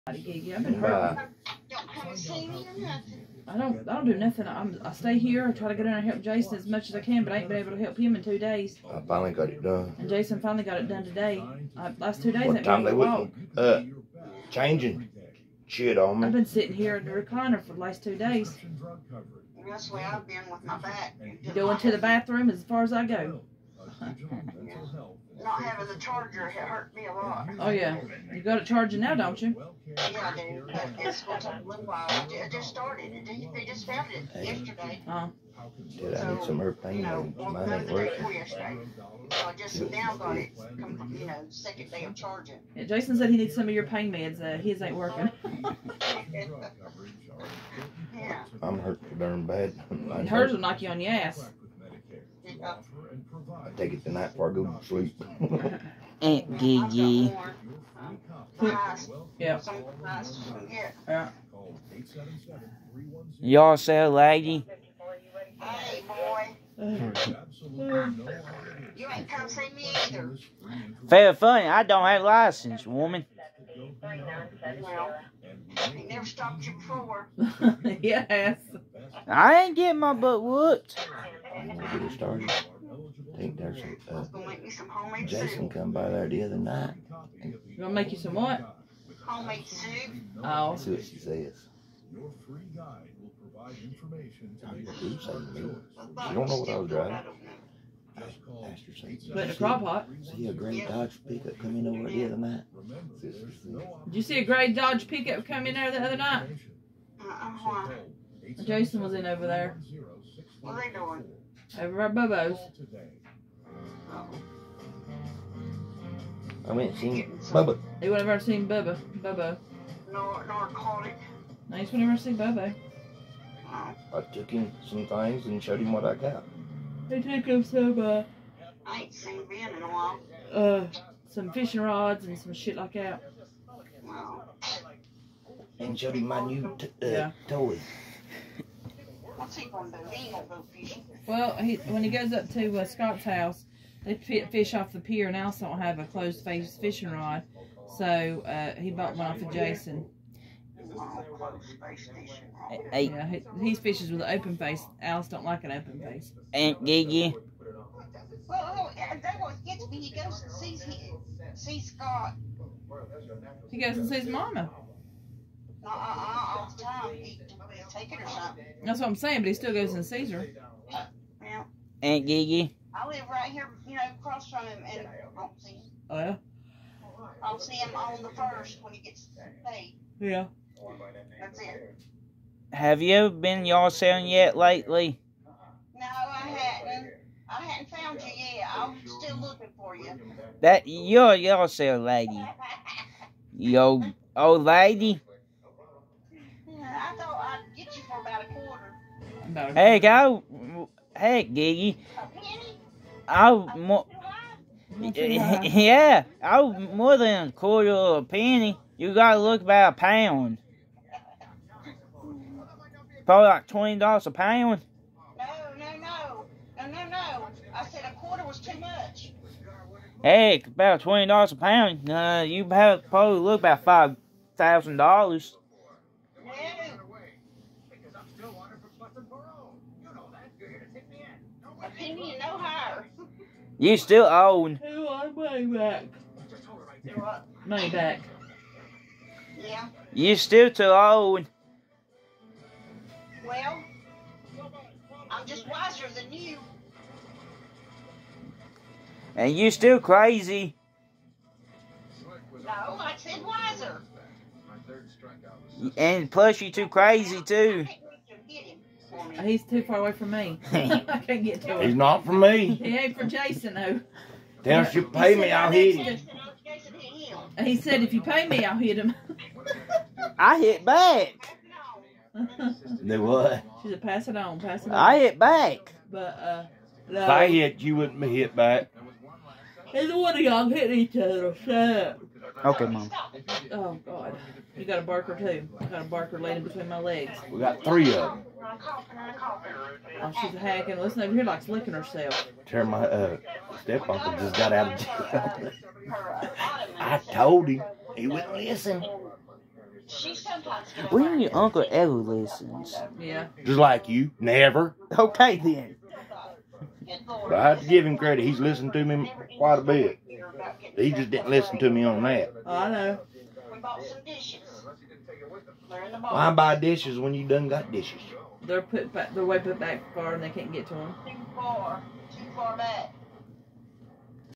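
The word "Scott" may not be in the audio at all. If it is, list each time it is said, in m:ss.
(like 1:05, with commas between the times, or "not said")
2:22, 2:41.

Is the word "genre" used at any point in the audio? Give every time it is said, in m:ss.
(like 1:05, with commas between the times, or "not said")
not said.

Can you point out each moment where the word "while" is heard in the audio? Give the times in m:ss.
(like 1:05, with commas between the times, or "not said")
0:31, 2:09.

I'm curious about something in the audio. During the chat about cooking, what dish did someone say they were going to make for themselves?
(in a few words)
Homemade soup.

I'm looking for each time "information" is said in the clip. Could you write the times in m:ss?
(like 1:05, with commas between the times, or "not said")
1:33.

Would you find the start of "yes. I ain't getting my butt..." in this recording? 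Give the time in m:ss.
1:18.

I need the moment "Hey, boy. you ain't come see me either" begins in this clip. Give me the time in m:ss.
1:05.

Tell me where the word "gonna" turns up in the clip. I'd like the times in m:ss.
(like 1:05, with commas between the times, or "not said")
0:31, 1:27.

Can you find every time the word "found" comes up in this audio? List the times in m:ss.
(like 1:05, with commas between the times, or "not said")
0:33, 3:07.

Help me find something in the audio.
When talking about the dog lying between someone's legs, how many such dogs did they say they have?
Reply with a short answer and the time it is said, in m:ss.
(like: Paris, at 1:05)
3, at 4:47.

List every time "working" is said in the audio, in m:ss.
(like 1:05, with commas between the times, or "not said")
0:37, 0:44.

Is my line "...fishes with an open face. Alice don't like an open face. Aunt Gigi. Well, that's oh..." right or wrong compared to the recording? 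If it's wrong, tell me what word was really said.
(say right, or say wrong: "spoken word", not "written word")
right.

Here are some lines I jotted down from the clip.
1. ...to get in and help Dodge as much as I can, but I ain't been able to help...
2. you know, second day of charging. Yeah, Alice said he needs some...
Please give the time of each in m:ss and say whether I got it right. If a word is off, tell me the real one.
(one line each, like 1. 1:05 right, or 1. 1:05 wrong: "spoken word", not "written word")
1. 0:05 wrong: "Jason", not "Dodge"
2. 0:40 wrong: "Jason", not "Alice".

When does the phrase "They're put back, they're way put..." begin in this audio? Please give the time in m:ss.
5:18.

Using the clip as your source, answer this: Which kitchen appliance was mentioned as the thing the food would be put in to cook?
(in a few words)
Crock-Pot.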